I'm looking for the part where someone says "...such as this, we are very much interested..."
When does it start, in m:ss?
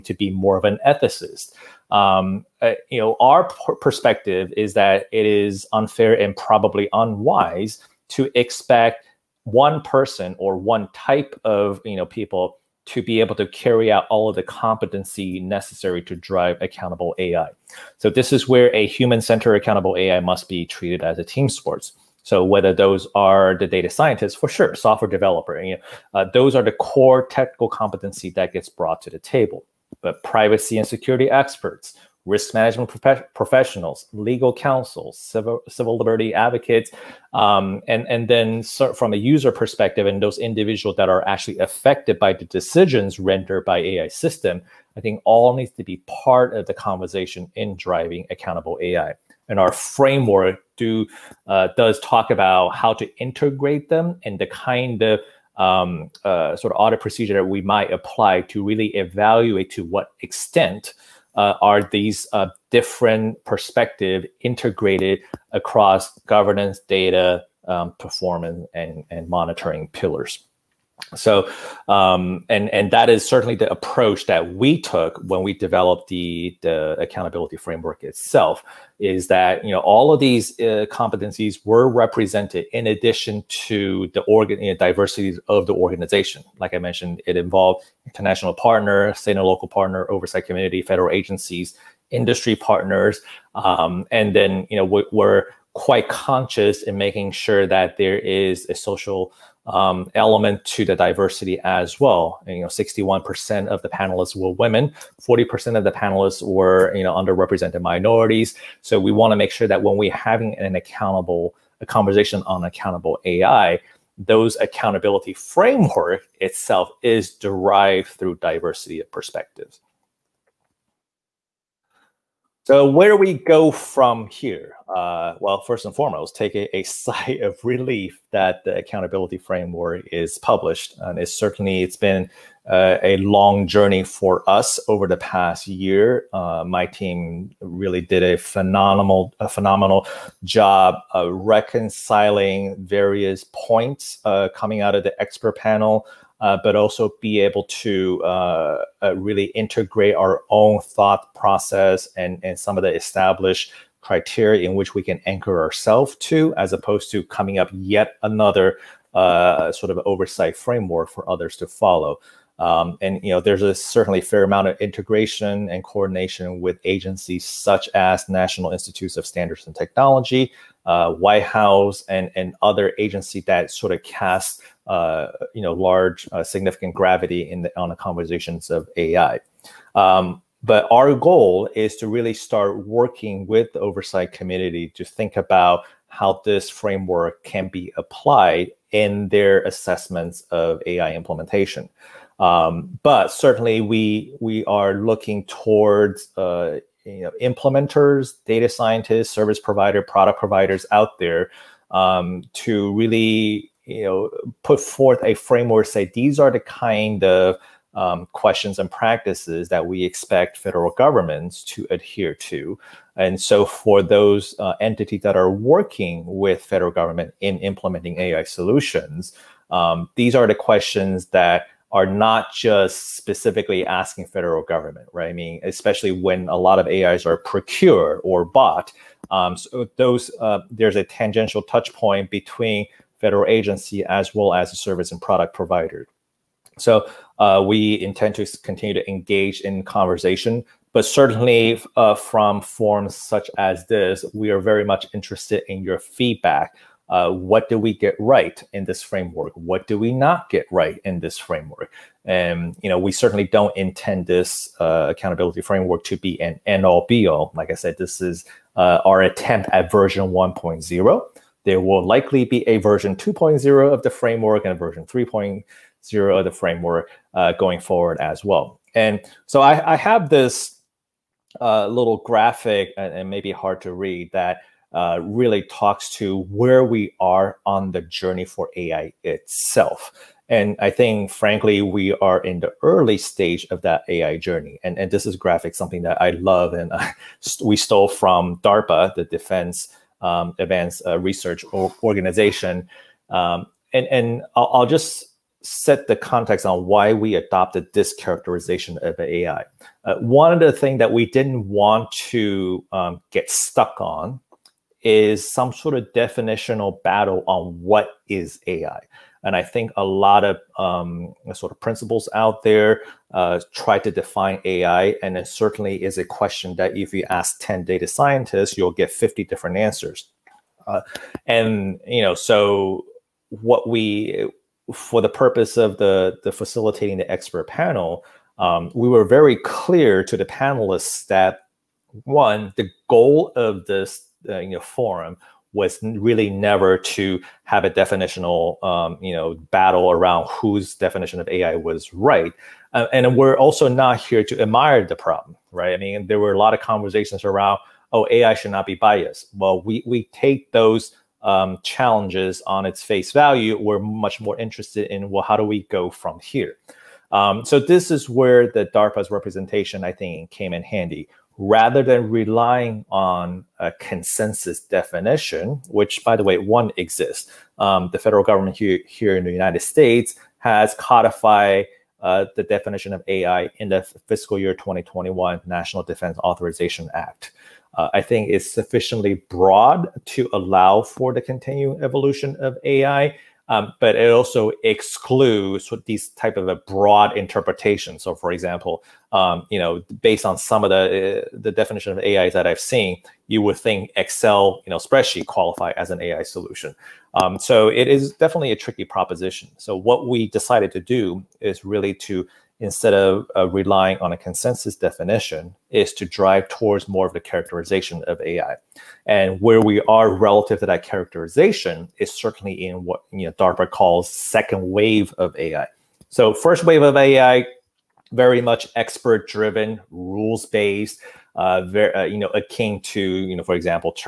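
4:03.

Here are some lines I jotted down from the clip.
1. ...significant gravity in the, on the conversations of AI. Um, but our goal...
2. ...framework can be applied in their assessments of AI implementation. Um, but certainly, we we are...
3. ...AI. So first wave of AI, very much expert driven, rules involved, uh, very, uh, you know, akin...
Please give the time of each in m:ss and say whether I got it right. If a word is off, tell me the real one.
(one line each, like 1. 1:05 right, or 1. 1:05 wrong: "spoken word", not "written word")
1. 2:56 right
2. 3:06 right
3. 6:55 wrong: "based", not "involved".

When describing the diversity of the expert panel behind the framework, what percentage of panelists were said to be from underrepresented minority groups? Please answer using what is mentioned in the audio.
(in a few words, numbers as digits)
40%.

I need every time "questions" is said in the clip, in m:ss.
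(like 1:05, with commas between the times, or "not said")
3:28, 3:40, 5:16.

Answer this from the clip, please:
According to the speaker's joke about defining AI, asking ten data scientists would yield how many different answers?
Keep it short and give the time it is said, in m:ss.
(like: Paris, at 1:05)
50, at 5:19.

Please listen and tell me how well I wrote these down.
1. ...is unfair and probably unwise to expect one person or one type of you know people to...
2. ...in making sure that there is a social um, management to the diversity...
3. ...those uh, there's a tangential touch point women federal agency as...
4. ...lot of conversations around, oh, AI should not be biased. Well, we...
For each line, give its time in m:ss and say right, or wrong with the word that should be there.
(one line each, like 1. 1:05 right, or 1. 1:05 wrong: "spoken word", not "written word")
1. 0:05 right
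2. 1:36 wrong: "element", not "management"
3. 3:49 wrong: "between", not "women"
4. 5:46 right.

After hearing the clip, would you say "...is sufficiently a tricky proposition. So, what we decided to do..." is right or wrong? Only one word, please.
wrong.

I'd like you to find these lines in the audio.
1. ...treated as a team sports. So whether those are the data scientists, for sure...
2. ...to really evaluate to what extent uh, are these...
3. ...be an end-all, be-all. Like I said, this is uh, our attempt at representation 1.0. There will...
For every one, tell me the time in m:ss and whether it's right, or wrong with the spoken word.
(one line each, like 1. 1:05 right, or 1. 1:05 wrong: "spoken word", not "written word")
1. 0:20 right
2. 0:58 right
3. 4:16 wrong: "version", not "representation".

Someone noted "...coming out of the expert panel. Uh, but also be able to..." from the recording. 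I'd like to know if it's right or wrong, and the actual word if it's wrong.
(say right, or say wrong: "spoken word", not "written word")
right.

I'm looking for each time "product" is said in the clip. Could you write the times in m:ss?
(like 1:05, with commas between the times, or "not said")
3:20, 3:55.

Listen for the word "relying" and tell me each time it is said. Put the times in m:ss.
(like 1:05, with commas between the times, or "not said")
6:02, 6:43.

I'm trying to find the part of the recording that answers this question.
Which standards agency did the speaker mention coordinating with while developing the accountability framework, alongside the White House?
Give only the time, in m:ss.
2:48.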